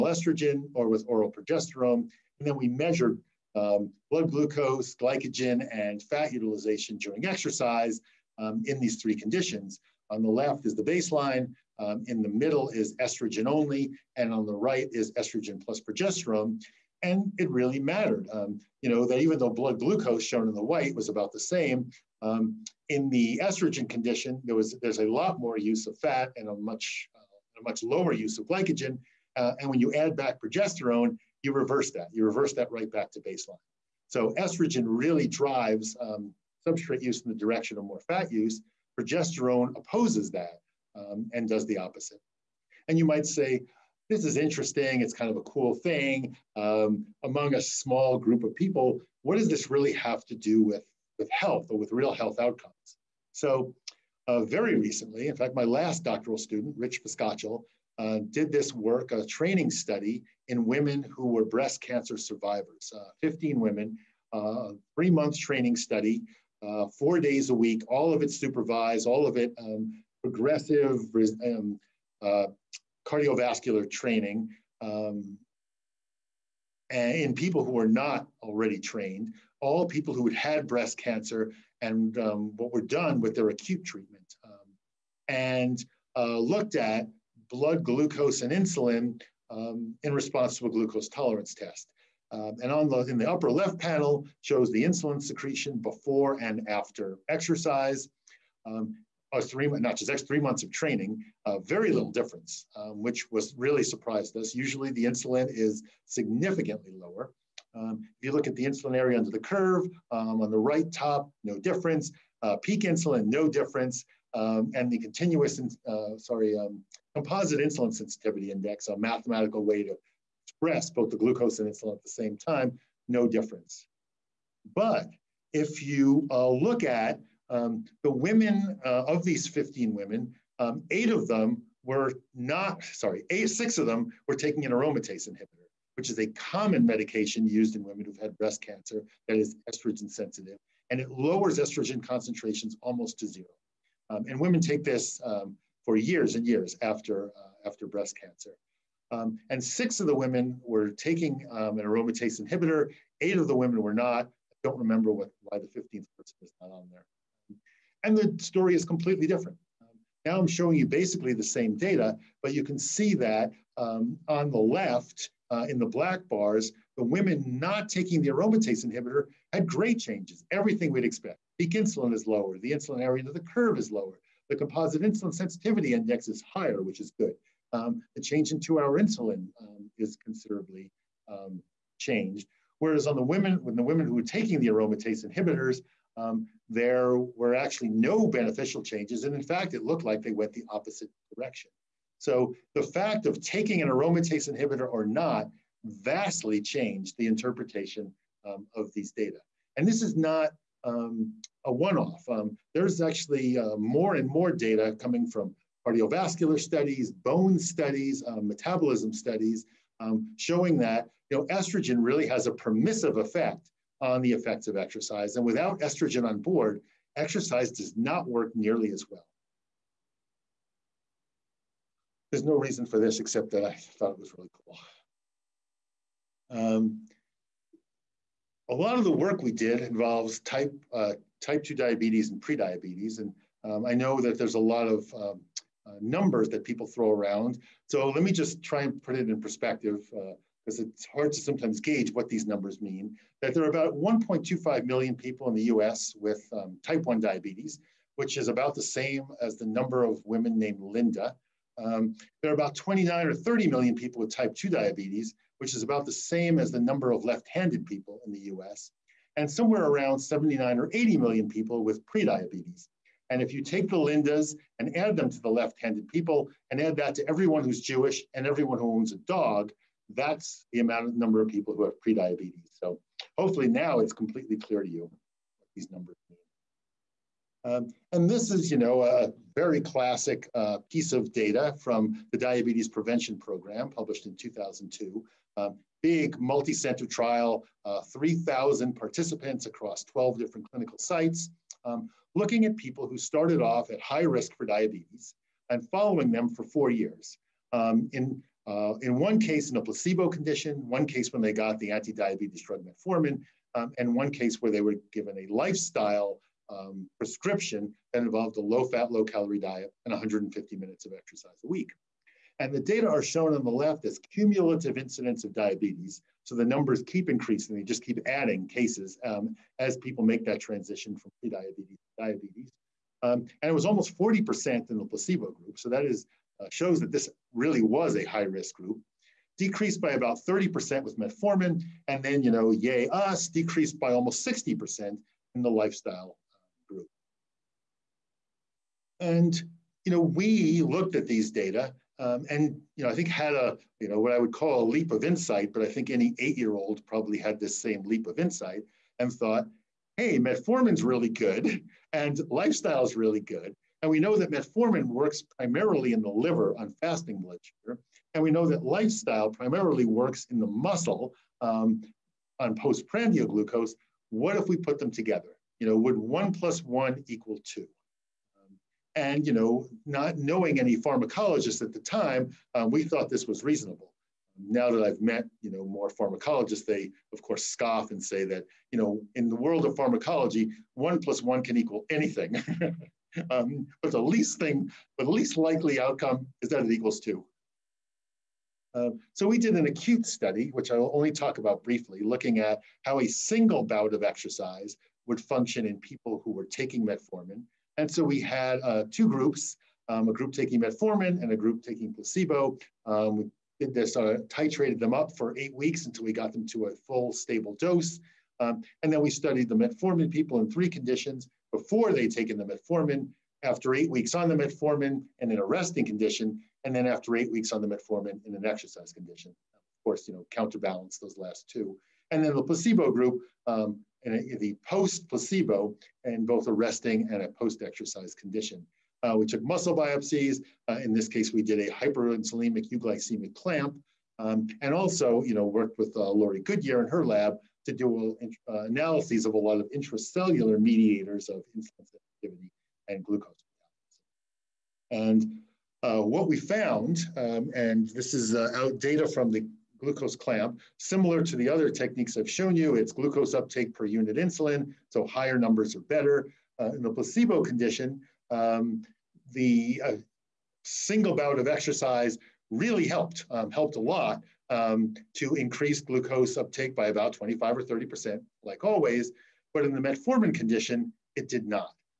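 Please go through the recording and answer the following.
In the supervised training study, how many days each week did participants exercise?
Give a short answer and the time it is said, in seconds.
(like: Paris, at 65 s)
4 days, at 66 s.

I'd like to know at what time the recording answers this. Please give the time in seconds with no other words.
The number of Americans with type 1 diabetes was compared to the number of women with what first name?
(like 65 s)
250 s.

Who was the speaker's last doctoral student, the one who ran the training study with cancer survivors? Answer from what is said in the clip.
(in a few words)
Rich Viskochil.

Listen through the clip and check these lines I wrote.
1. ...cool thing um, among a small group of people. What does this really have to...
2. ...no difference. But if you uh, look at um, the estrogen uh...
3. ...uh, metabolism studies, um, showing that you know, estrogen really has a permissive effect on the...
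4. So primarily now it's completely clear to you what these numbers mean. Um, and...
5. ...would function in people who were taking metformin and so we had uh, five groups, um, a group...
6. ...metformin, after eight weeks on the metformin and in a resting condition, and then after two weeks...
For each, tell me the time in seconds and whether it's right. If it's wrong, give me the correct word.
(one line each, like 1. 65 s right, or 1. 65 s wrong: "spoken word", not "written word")
1. 45 s right
2. 123 s wrong: "women", not "estrogen"
3. 208 s right
4. 272 s wrong: "hopefully", not "primarily"
5. 395 s wrong: "two", not "five"
6. 412 s wrong: "eight", not "two".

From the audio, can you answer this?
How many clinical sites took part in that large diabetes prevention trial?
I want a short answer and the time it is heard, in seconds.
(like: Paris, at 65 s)
12, at 290 s.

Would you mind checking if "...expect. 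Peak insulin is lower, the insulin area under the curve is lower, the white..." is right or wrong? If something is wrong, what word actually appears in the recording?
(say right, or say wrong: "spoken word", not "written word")
wrong: "composite", not "white".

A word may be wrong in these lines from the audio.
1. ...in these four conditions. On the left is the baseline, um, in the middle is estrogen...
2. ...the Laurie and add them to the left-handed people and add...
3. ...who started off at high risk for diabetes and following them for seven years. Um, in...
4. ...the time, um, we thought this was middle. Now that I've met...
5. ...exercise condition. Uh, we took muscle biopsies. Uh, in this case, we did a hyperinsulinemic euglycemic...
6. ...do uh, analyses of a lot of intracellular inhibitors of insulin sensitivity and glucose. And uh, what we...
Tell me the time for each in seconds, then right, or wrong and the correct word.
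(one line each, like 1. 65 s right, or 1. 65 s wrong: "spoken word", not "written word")
1. 8 s wrong: "three", not "four"
2. 263 s wrong: "Lindas", not "Laurie"
3. 293 s wrong: "four", not "seven"
4. 371 s wrong: "reasonable", not "middle"
5. 427 s right
6. 437 s wrong: "mediators", not "inhibitors".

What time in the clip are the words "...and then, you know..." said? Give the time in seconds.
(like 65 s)
332 s.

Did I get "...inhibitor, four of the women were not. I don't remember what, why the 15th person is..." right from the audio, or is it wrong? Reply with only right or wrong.
wrong.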